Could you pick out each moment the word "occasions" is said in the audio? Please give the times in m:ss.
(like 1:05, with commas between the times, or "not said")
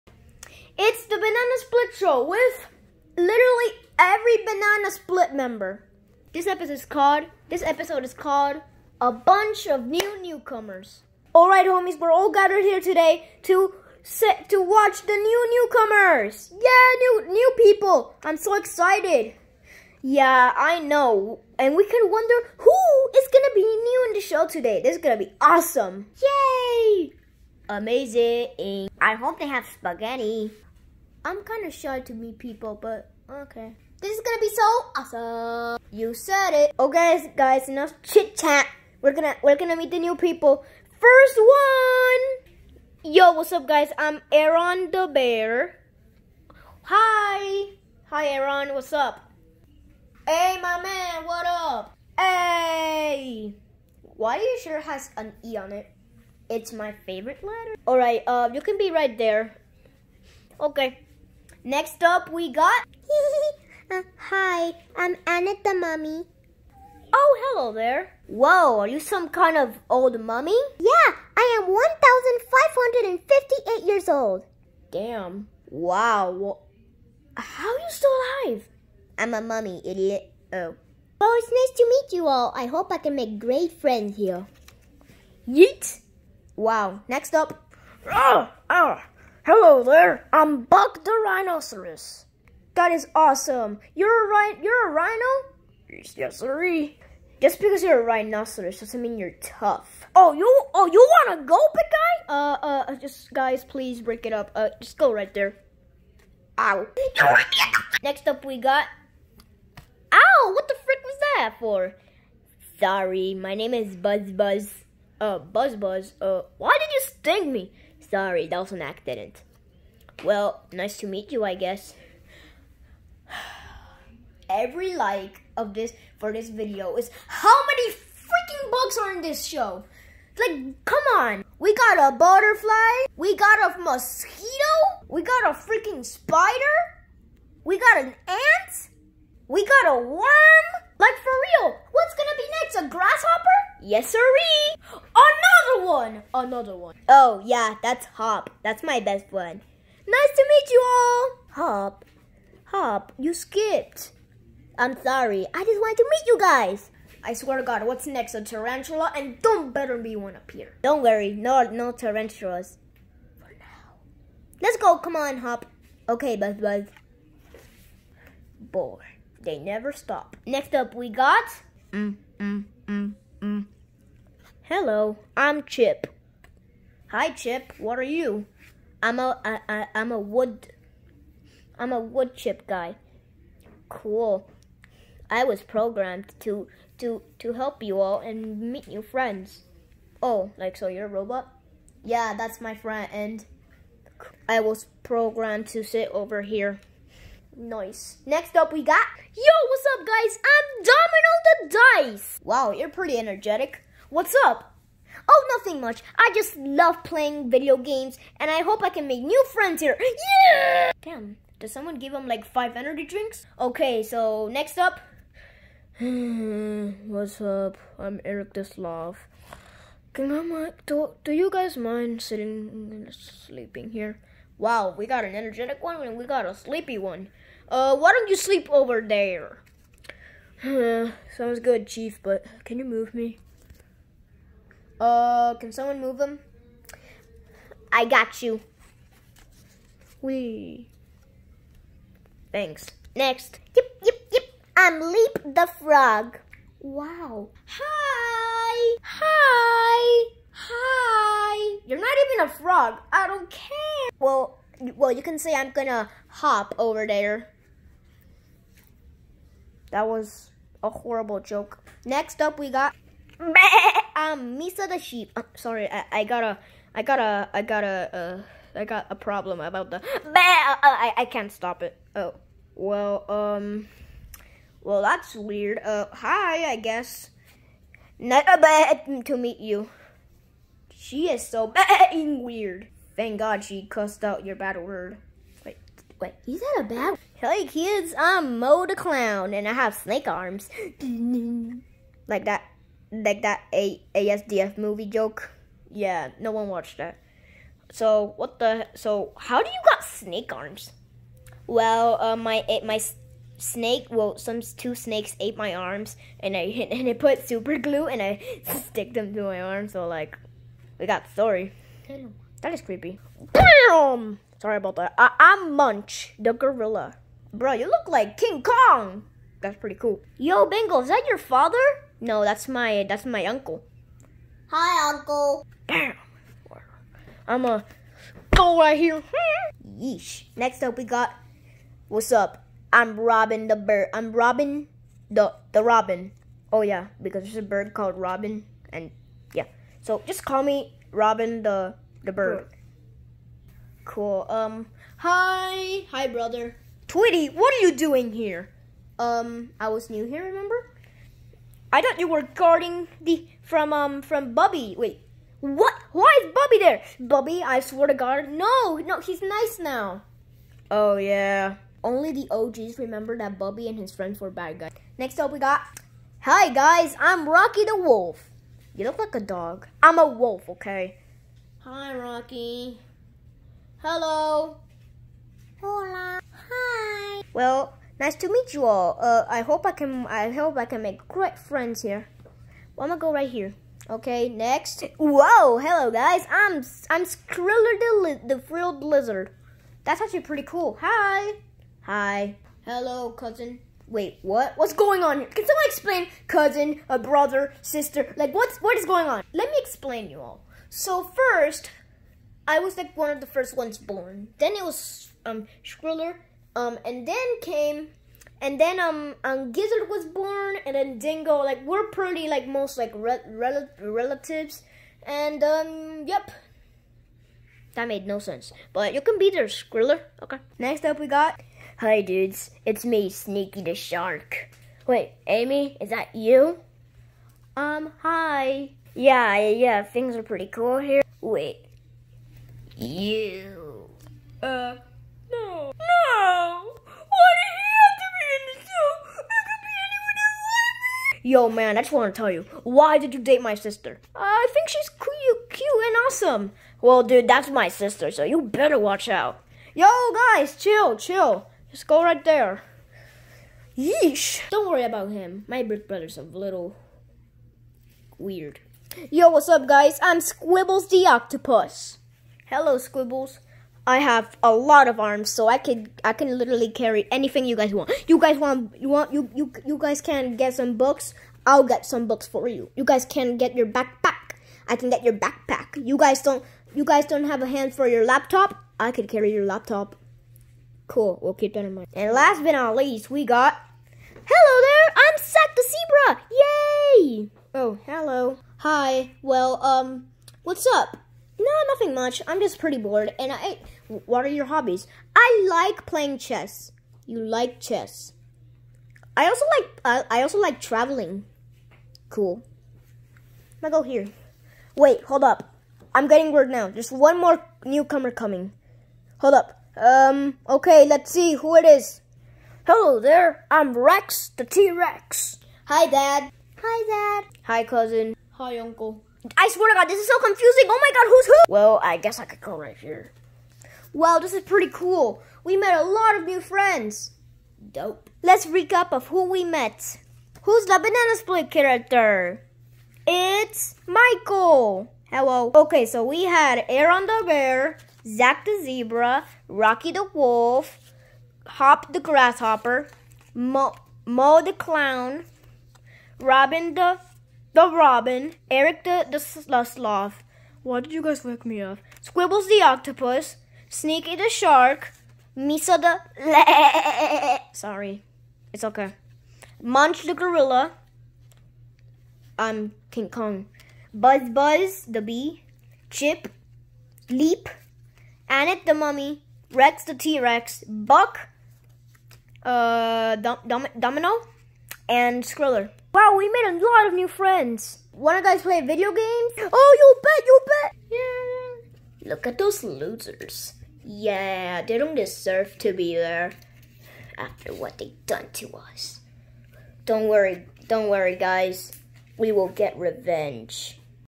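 not said.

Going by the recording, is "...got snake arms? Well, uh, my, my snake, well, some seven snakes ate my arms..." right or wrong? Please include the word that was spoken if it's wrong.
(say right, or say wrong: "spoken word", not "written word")
wrong: "two", not "seven".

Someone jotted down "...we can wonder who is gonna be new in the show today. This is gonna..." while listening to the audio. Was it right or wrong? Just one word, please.
right.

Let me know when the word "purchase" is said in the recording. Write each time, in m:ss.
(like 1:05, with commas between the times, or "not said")
not said.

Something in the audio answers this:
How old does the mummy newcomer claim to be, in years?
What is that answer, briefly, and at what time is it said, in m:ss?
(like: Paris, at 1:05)
1,558, at 1:11.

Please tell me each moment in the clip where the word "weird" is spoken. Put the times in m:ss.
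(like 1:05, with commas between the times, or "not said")
4:35, 4:42, 7:38.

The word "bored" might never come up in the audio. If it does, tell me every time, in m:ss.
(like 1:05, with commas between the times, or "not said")
2:48, 8:12.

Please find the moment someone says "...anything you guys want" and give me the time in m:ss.
7:47.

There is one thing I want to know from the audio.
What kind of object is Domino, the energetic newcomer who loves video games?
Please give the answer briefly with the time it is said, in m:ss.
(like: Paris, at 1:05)
Dice, at 3:20.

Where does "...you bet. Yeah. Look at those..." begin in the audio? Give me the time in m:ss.
9:40.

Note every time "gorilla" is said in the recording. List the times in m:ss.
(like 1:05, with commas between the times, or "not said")
5:16, 9:20.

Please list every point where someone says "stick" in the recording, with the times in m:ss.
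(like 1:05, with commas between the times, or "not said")
5:08.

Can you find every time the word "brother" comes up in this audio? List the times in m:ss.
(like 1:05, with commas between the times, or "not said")
5:46, 6:37, 7:36.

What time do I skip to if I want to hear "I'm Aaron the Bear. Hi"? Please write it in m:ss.
0:43.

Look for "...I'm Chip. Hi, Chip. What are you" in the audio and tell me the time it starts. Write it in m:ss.
2:55.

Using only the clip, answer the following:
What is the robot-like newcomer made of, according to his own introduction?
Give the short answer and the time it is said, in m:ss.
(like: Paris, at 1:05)
Wood chip, at 3:01.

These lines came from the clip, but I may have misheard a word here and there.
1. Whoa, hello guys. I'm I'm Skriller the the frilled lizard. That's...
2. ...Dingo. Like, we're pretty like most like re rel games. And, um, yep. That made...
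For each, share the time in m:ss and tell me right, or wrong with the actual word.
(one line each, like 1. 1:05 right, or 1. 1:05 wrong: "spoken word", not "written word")
1. 6:25 right
2. 6:51 wrong: "relatives", not "games".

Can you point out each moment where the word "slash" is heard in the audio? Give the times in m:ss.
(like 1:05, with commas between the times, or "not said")
not said.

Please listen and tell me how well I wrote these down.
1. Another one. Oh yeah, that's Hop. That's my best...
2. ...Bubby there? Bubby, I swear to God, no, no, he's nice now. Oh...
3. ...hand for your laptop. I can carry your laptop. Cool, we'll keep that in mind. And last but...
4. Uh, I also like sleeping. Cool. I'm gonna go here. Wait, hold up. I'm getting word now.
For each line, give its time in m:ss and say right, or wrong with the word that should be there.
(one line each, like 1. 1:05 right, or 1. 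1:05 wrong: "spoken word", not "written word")
1. 2:26 right
2. 5:56 right
3. 7:57 right
4. 8:20 wrong: "traveling", not "sleeping".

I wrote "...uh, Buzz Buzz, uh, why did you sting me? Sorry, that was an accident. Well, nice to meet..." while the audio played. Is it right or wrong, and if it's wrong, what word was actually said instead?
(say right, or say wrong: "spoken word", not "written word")
right.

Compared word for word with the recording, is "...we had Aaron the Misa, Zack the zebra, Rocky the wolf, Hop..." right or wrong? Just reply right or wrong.
wrong.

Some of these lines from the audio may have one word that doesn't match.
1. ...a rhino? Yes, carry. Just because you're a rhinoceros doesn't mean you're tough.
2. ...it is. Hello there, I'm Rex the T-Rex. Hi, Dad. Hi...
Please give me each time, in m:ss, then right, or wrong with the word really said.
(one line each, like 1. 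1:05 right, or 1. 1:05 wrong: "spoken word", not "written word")
1. 1:34 wrong: "sorry", not "carry"
2. 8:31 right.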